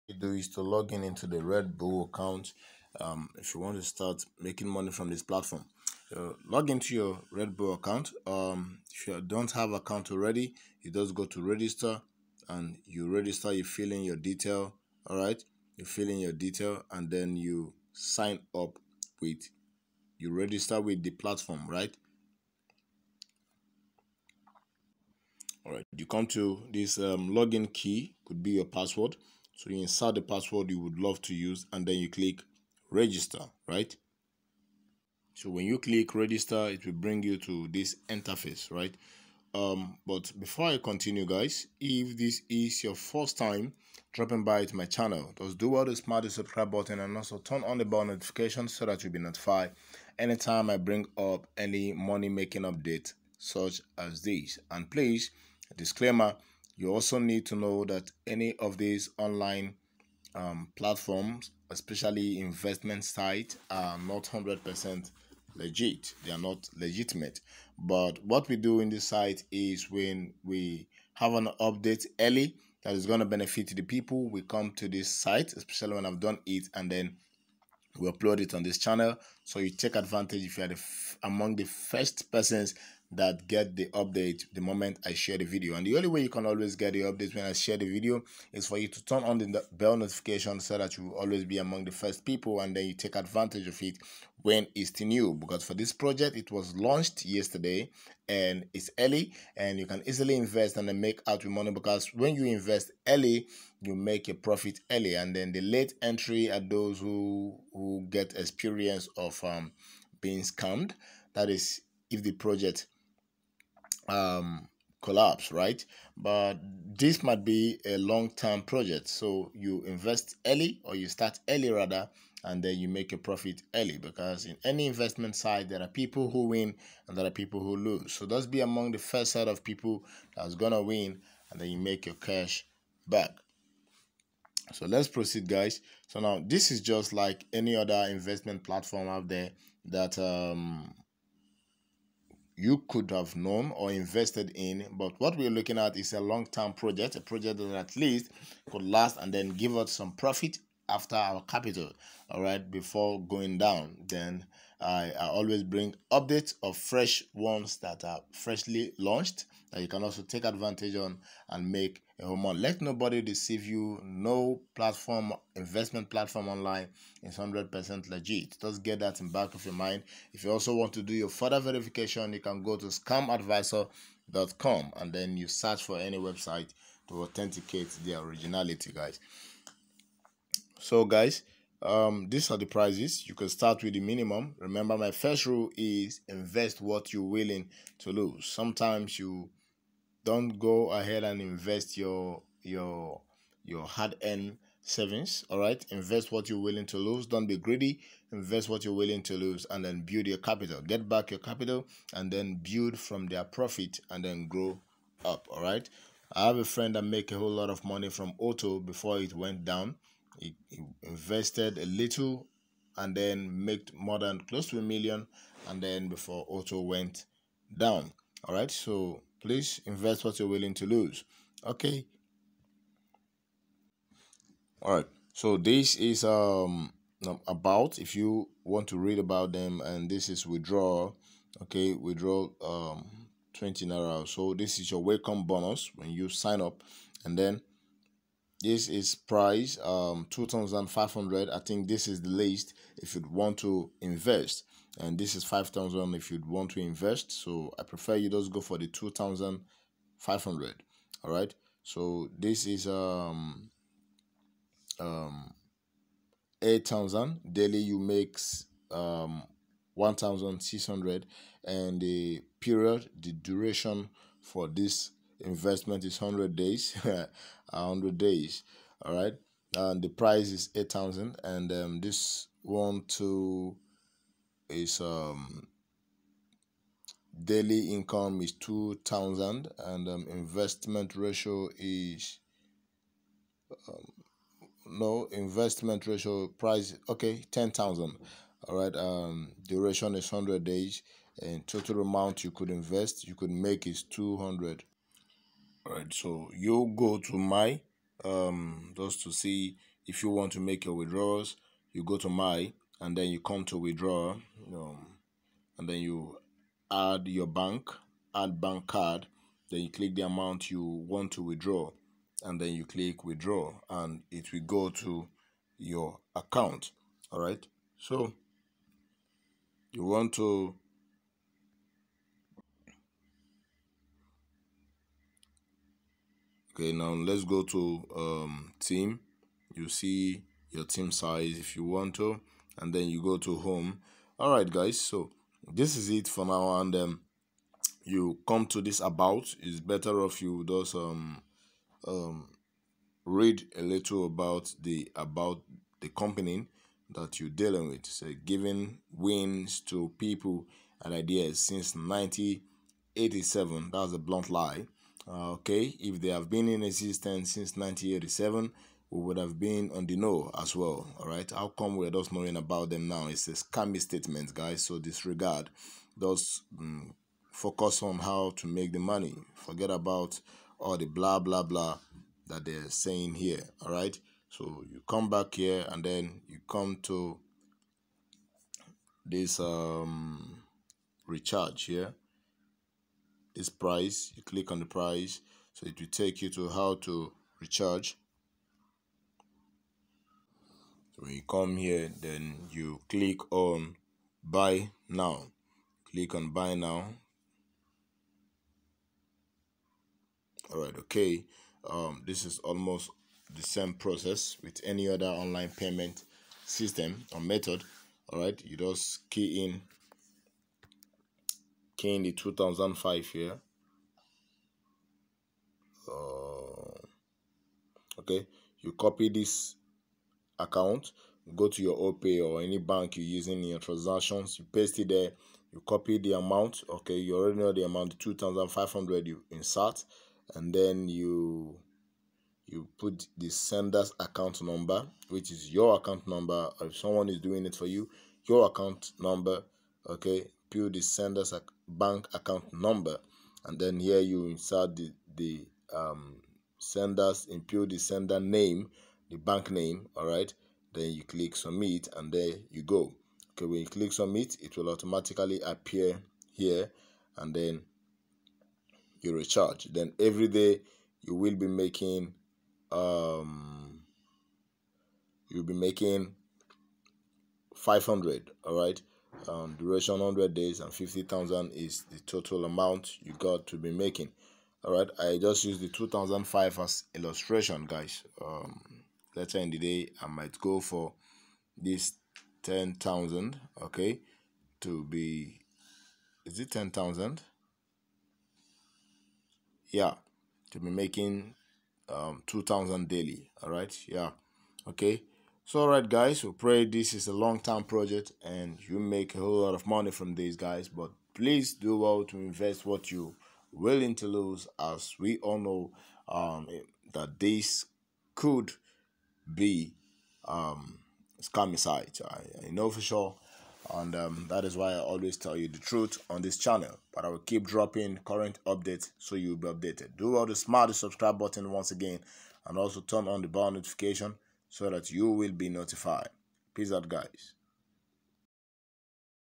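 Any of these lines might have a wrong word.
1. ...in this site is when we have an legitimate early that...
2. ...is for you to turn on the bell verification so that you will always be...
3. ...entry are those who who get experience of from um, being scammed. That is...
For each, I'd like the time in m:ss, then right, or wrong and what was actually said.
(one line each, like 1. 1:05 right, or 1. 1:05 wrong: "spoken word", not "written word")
1. 1:08 wrong: "update", not "legitimate"
2. 1:28 wrong: "notification", not "verification"
3. 1:46 right.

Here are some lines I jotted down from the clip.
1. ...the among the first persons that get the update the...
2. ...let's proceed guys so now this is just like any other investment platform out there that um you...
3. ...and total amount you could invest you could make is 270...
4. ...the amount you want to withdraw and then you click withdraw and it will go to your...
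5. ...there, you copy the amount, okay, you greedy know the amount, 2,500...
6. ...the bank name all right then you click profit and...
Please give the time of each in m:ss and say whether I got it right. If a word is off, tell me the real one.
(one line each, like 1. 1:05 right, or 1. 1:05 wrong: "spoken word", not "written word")
1. 1:20 right
2. 2:14 right
3. 4:51 wrong: "200", not "270"
4. 5:10 right
5. 7:05 wrong: "already", not "greedy"
6. 7:29 wrong: "submit", not "profit".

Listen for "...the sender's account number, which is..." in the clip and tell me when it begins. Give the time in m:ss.
7:13.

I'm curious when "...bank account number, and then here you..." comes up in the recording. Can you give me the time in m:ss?
7:21.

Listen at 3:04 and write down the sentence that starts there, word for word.
Remember, my first rule is invest what you're willing to lose.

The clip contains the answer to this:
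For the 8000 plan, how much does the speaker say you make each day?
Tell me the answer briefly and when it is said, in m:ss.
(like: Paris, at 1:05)
1600, at 4:19.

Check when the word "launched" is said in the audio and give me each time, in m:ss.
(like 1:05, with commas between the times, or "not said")
1:36, 2:38.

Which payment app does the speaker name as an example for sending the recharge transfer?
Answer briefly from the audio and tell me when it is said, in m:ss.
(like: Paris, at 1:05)
OPay, at 7:01.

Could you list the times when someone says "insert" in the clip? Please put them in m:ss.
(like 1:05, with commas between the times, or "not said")
0:29, 7:09, 7:24.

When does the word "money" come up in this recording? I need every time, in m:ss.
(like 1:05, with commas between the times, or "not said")
0:04, 0:51, 1:41, 3:27, 6:08, 8:19.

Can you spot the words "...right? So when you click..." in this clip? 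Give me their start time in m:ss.
0:33.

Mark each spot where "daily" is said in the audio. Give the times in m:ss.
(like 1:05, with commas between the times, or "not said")
4:17, 4:37, 8:13.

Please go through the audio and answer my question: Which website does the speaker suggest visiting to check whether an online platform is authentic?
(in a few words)
scamadviser.com.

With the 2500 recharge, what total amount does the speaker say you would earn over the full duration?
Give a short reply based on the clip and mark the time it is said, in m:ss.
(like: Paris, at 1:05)
50,000, at 7:50.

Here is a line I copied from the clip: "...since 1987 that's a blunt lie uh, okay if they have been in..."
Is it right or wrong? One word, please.
right.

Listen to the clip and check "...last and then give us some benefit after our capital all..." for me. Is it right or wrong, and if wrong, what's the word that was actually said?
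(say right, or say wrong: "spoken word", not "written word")
wrong: "profit", not "benefit".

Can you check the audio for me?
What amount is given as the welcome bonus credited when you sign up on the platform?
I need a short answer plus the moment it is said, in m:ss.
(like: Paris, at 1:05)
20 naira, at 3:53.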